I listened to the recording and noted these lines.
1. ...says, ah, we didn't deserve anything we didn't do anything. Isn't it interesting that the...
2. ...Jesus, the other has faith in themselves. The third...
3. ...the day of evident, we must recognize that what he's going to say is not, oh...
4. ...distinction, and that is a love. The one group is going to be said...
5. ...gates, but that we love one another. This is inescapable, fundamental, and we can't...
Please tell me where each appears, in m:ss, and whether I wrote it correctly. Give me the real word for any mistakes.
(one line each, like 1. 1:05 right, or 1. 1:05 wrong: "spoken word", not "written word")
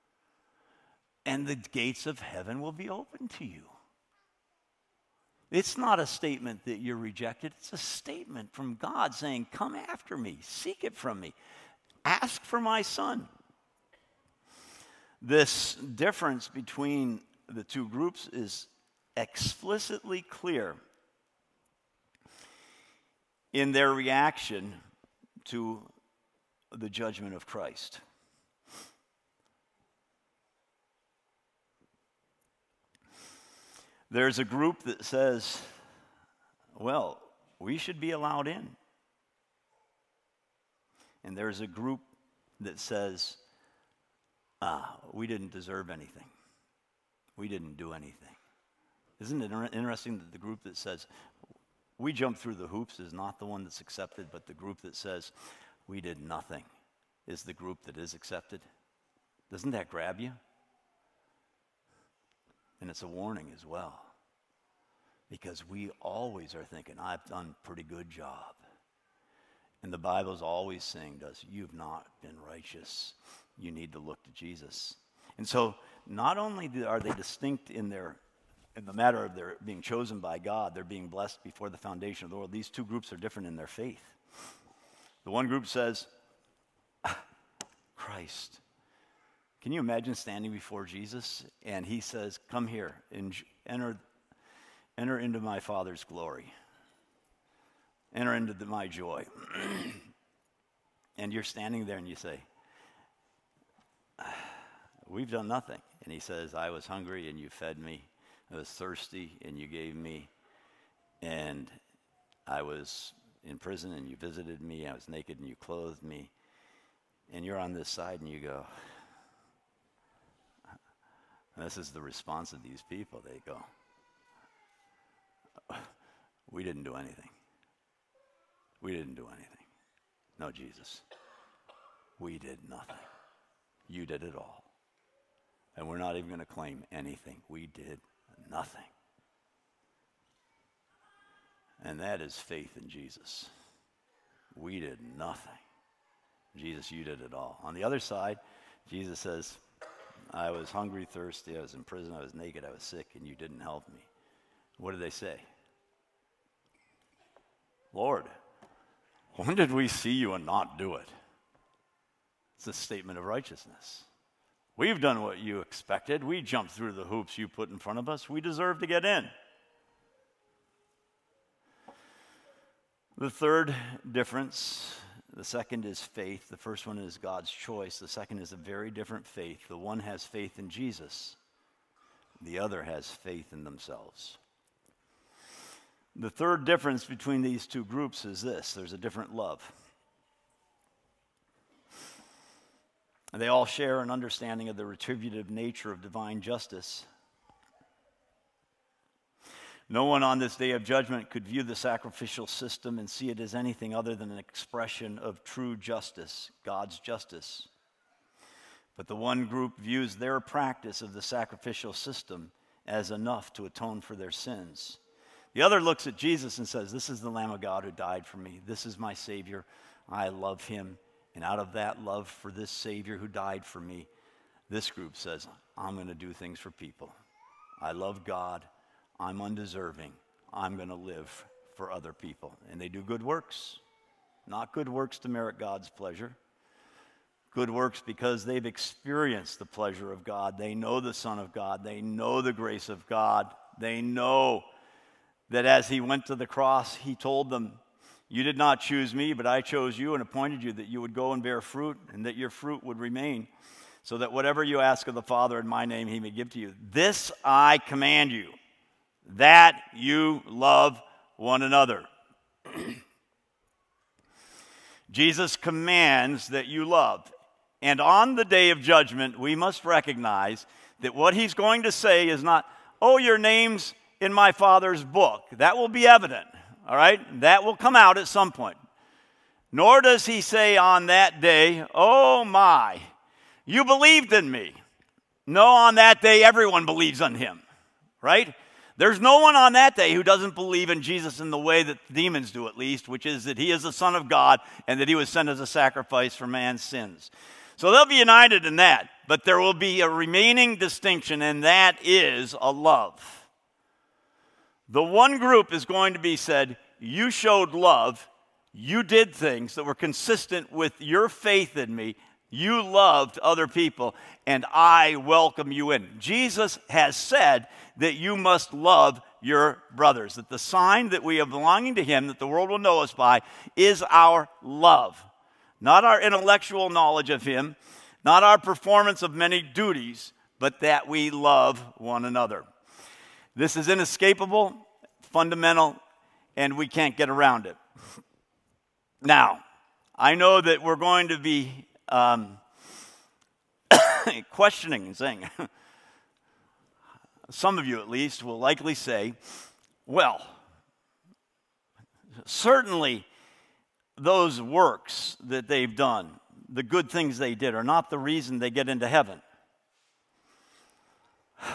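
1. 0:42 right
2. 3:00 right
3. 4:28 wrong: "judgment", not "evident"
4. 5:00 right
5. 5:29 wrong: "duties", not "gates".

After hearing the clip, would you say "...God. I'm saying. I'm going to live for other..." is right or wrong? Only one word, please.
wrong.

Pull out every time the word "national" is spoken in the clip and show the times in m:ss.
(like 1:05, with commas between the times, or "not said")
not said.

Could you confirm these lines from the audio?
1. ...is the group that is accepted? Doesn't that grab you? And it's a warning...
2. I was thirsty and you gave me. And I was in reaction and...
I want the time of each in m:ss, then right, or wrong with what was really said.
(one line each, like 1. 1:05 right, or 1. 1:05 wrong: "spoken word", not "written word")
1. 0:57 right
2. 1:48 wrong: "prison", not "reaction".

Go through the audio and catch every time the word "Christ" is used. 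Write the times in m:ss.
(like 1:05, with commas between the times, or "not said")
0:27, 1:27.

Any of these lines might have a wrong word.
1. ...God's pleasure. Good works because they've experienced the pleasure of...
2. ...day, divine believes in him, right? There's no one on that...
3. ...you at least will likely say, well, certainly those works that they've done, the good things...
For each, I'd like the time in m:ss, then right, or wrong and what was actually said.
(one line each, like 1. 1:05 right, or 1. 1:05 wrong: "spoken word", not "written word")
1. 3:55 right
2. 4:46 wrong: "everyone", not "divine"
3. 5:47 right.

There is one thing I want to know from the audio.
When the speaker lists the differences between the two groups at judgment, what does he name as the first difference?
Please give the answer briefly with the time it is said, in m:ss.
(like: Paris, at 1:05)
God's choice, at 2:57.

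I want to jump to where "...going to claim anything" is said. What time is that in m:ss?
2:16.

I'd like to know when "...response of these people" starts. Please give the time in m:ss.
2:02.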